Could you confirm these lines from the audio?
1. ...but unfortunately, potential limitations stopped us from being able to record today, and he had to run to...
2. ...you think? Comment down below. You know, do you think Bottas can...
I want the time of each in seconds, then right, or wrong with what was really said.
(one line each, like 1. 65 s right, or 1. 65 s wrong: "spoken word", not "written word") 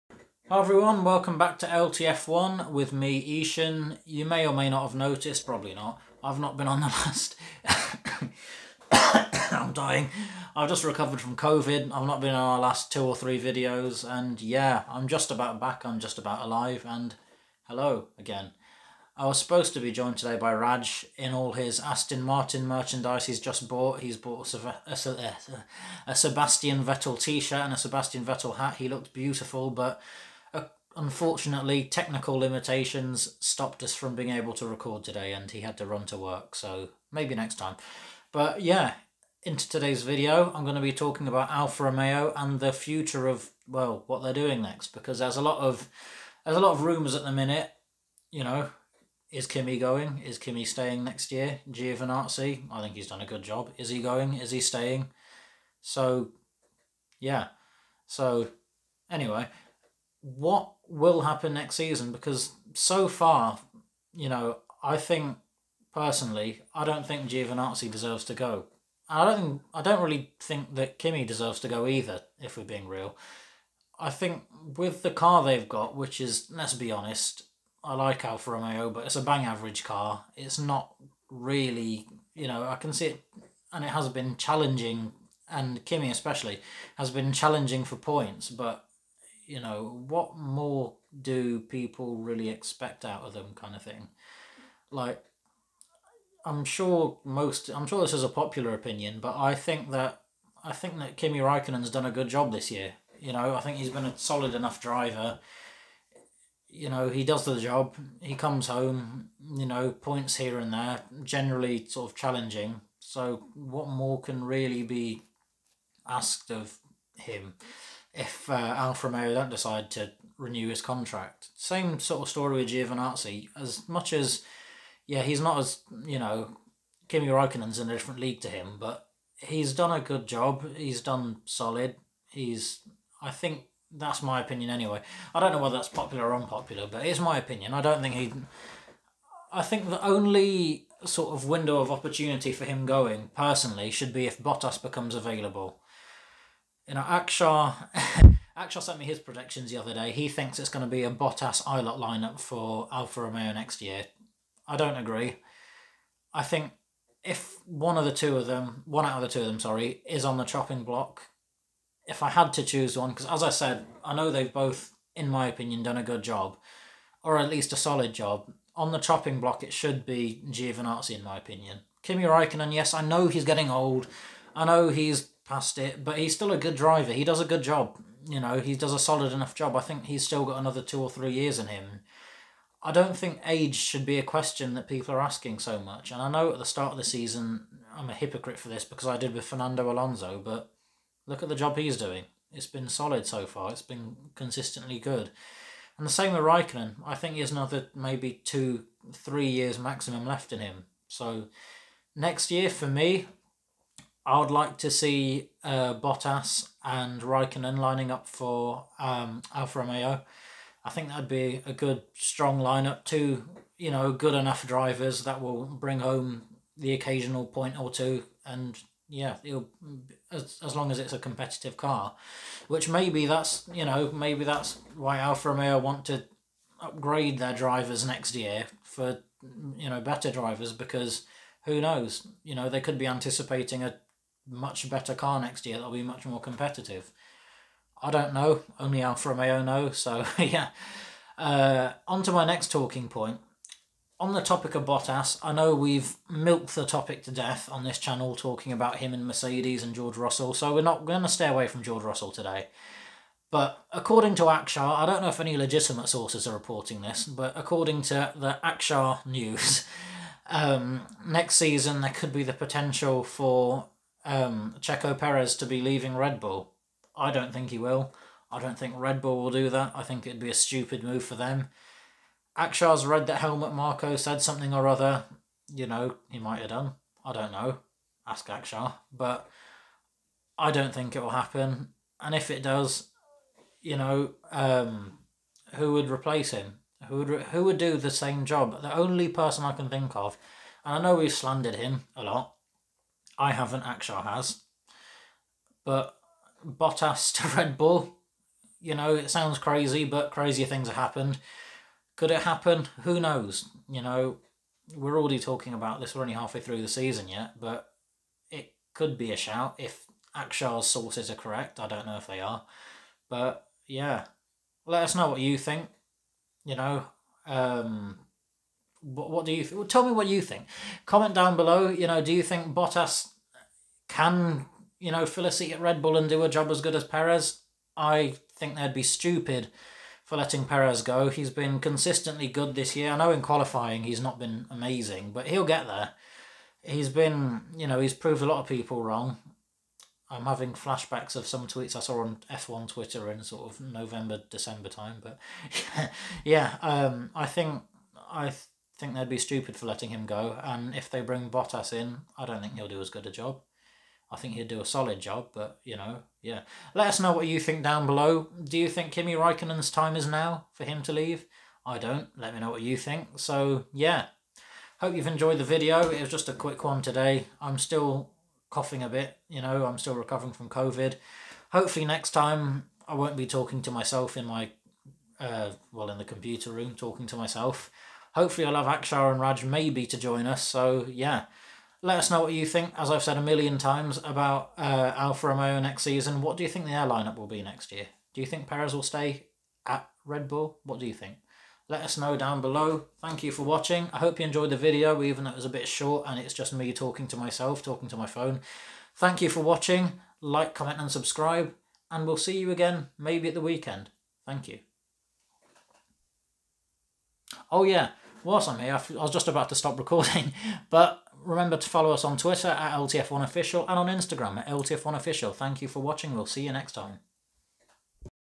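1. 29 s wrong: "technical", not "potential"
2. 320 s right.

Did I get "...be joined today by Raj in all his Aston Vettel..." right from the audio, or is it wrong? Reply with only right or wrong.
wrong.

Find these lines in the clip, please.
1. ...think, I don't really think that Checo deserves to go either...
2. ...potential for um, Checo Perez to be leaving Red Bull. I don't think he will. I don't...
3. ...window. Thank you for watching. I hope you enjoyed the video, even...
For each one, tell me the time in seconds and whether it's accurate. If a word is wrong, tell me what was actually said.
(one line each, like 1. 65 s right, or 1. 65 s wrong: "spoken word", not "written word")
1. 69 s wrong: "Kimi", not "Checo"
2. 262 s right
3. 392 s wrong: "below", not "window".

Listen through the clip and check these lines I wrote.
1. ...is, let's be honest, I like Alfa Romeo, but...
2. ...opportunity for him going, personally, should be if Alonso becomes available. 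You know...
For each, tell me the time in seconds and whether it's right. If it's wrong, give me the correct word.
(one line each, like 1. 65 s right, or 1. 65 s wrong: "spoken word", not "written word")
1. 76 s right
2. 141 s wrong: "Bottas", not "Alonso".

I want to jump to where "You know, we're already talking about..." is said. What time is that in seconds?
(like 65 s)
303 s.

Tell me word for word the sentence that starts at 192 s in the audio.
It's been solid so far, it's been consistently good.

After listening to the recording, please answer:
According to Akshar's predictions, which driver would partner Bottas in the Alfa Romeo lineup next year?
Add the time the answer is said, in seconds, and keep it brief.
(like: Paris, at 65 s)
Ilott, at 151 s.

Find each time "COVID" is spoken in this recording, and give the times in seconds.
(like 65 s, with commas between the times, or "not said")
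11 s, 370 s.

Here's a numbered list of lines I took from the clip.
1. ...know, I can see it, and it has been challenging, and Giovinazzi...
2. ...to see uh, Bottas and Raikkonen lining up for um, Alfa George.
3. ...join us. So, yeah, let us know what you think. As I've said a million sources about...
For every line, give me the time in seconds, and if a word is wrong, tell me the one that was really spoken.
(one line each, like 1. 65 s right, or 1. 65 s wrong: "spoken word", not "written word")
1. 82 s wrong: "Kimi", not "Giovinazzi"
2. 204 s wrong: "Romeo", not "George"
3. 380 s wrong: "times", not "sources".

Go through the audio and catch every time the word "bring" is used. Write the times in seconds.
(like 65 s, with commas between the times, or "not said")
215 s, 351 s.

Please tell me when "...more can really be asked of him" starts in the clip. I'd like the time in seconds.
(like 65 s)
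113 s.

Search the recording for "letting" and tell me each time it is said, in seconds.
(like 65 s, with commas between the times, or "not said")
330 s, 349 s.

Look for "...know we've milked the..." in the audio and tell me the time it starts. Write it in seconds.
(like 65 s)
245 s.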